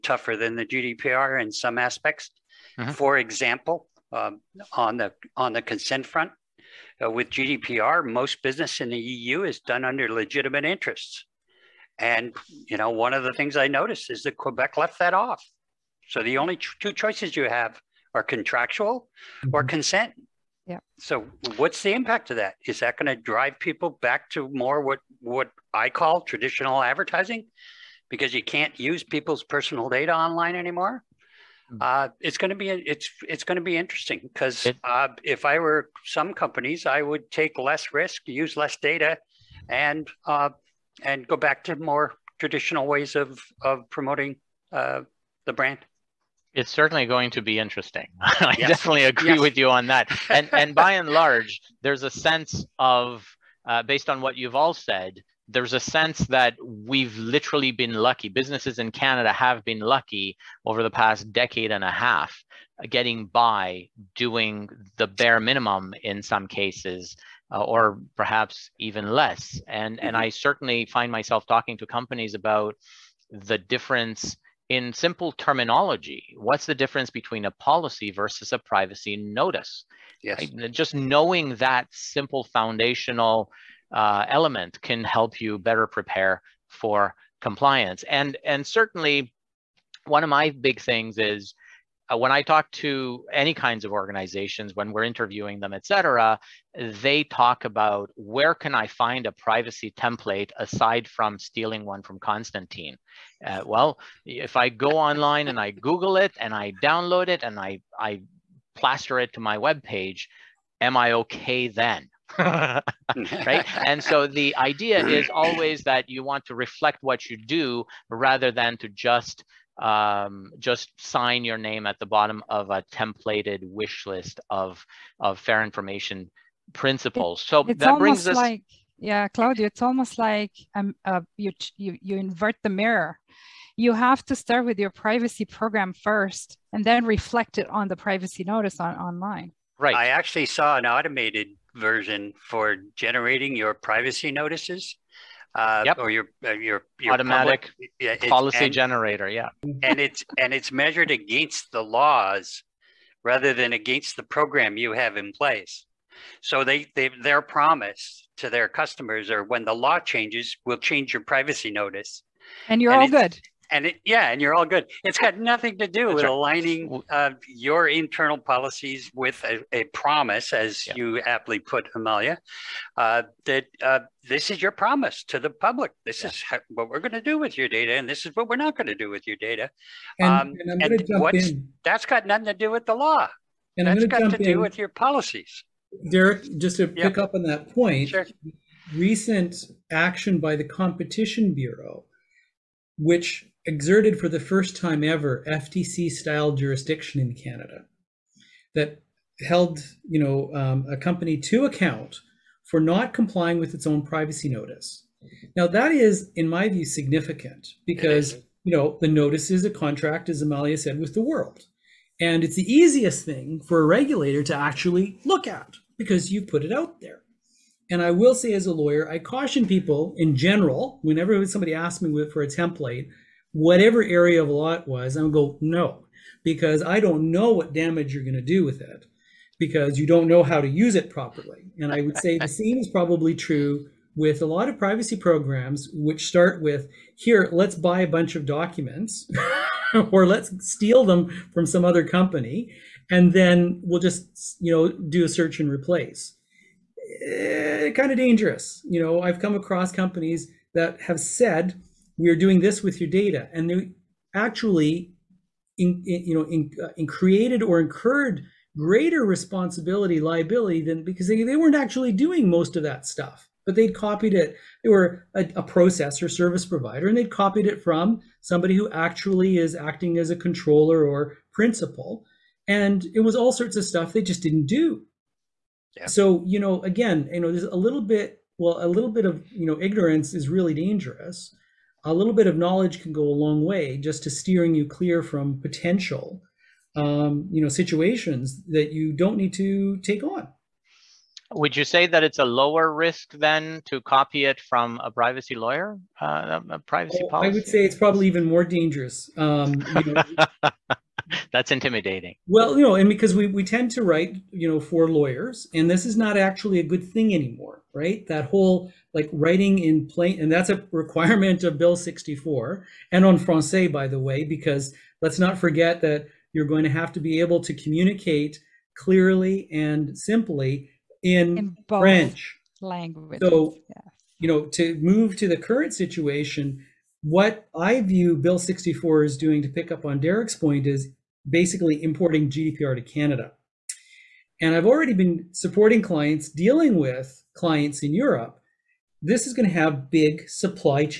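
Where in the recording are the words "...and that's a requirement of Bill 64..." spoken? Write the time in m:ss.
5:10.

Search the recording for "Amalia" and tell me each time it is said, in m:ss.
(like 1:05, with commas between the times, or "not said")
2:51, 3:30.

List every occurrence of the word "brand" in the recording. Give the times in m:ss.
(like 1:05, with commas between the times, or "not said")
0:45.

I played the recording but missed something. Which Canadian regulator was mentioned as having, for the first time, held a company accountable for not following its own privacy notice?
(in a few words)
Competition Bureau.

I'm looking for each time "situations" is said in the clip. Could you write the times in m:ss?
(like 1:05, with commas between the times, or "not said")
4:47, 5:25.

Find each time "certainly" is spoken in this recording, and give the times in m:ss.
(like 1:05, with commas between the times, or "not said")
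0:46, 1:10, 1:28.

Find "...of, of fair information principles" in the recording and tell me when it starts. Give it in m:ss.
2:04.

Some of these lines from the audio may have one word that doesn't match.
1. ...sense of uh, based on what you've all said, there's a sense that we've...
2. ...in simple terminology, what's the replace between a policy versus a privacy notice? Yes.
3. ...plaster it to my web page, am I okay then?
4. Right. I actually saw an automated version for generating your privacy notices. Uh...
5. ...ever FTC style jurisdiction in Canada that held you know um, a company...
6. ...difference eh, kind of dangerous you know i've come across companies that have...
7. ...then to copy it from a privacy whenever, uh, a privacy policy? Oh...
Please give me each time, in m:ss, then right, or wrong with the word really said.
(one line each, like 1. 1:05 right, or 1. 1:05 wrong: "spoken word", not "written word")
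1. 0:52 right
2. 1:14 wrong: "difference", not "replace"
3. 1:48 right
4. 2:19 right
5. 3:15 right
6. 4:05 wrong: "replace", not "difference"
7. 4:53 wrong: "lawyer", not "whenever".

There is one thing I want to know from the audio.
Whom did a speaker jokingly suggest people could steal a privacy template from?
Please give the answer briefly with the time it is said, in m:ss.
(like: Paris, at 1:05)
Constantine, at 1:42.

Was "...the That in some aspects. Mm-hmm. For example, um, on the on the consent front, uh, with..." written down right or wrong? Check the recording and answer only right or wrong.
wrong.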